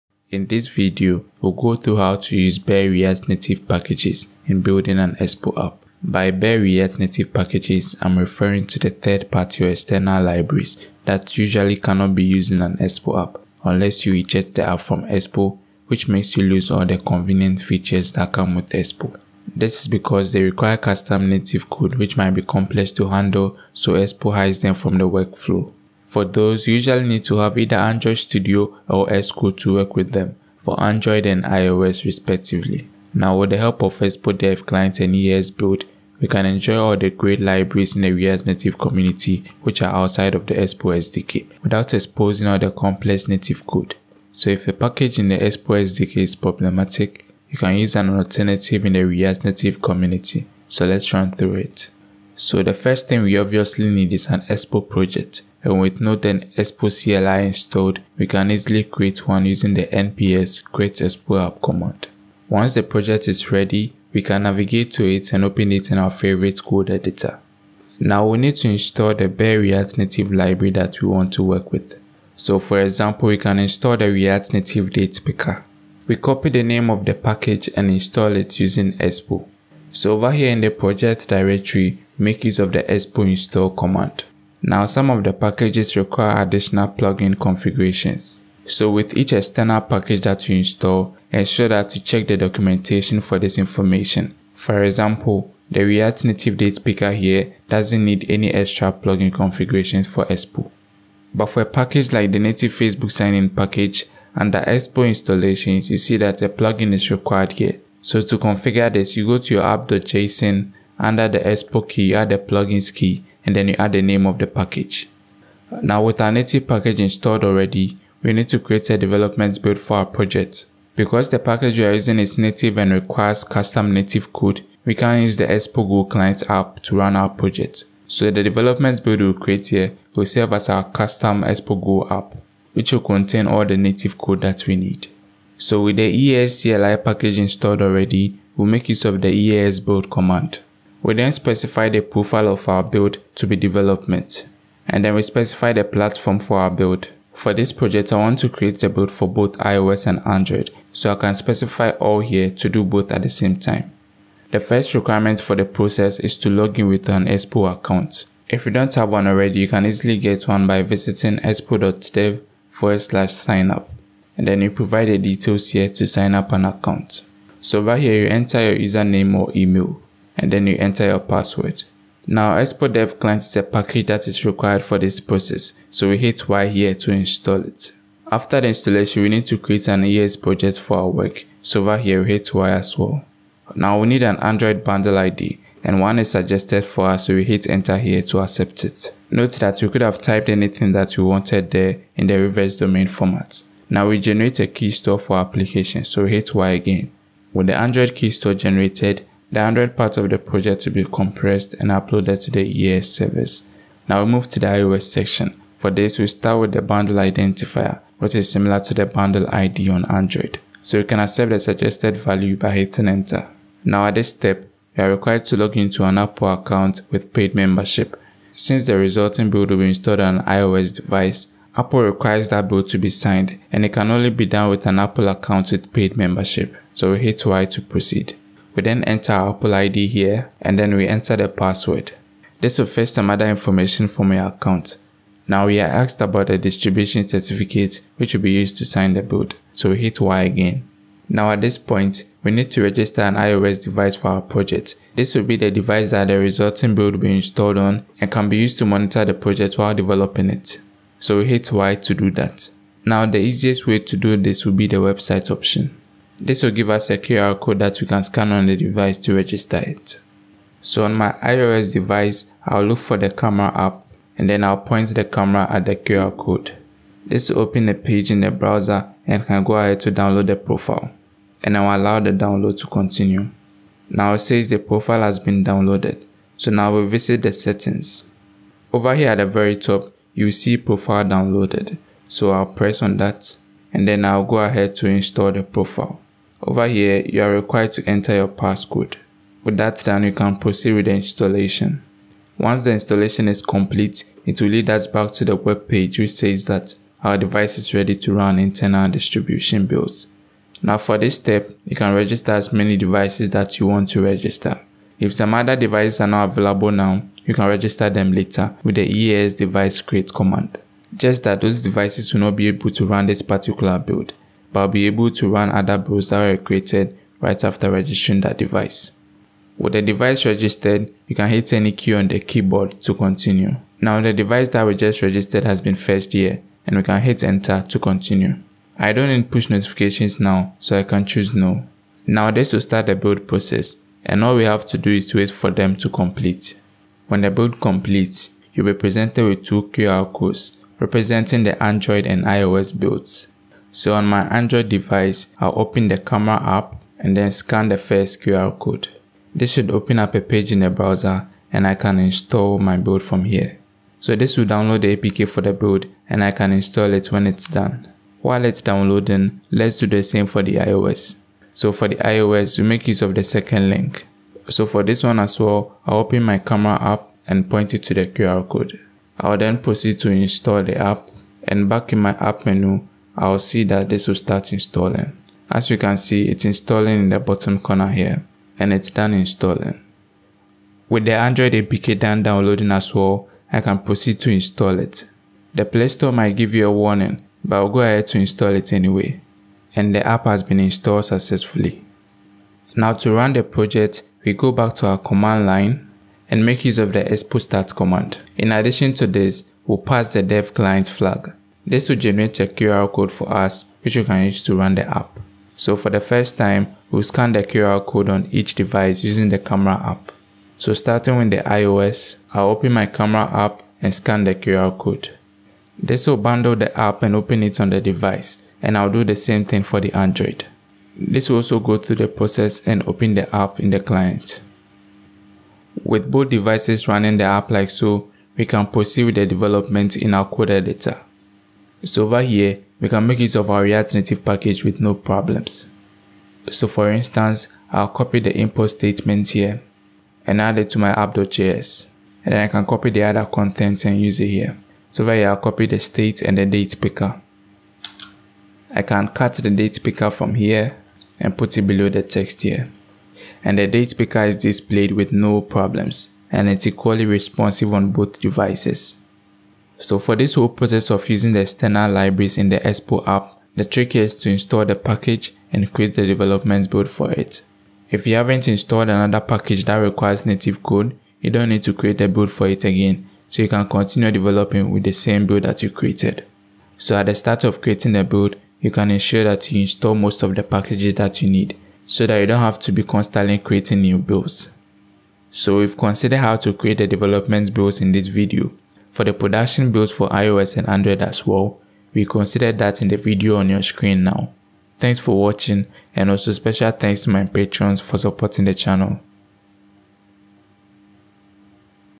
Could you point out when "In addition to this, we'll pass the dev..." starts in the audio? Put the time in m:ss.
6:38.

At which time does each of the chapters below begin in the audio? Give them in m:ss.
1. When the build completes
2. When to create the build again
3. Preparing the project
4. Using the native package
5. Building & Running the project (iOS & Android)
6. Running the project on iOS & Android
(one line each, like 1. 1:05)
1. 5:36
2. 7:47
3. 0:50
4. 7:08
5. 1:55
6. 6:32.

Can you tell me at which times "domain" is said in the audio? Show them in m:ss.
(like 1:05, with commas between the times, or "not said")
3:12.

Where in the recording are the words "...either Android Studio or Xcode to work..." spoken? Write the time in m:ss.
0:27.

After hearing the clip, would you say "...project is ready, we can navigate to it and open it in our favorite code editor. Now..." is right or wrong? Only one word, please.
right.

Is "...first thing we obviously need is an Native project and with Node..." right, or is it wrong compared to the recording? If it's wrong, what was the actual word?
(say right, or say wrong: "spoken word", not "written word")
wrong: "Expo", not "Native".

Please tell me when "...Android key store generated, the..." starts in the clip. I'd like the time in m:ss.
3:17.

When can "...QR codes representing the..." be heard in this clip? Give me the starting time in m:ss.
5:39.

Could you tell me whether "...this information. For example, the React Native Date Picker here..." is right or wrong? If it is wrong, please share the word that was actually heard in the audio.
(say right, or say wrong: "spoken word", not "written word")
right.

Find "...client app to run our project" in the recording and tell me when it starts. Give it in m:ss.
2:06.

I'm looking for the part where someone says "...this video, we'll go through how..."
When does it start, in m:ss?
0:00.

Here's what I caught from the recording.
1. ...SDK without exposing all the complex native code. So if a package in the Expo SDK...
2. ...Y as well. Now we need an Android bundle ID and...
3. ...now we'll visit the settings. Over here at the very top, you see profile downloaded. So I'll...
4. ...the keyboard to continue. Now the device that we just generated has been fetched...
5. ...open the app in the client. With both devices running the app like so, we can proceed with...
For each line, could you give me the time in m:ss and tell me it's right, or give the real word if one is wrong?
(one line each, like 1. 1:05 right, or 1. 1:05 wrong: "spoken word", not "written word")
1. 0:40 right
2. 3:02 right
3. 4:36 right
4. 5:22 wrong: "registered", not "generated"
5. 7:03 right.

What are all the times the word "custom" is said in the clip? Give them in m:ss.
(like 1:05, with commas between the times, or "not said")
0:20, 2:03, 2:10.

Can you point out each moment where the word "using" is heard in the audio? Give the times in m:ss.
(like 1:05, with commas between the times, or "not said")
0:59, 1:18, 2:01, 6:49, 7:41.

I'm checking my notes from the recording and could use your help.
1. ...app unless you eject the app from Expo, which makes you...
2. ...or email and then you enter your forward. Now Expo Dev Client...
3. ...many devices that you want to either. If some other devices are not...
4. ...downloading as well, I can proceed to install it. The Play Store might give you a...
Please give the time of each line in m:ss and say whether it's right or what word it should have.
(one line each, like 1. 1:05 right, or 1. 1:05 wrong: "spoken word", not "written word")
1. 0:13 right
2. 2:49 wrong: "password", not "forward"
3. 5:02 wrong: "register", not "either"
4. 6:22 right.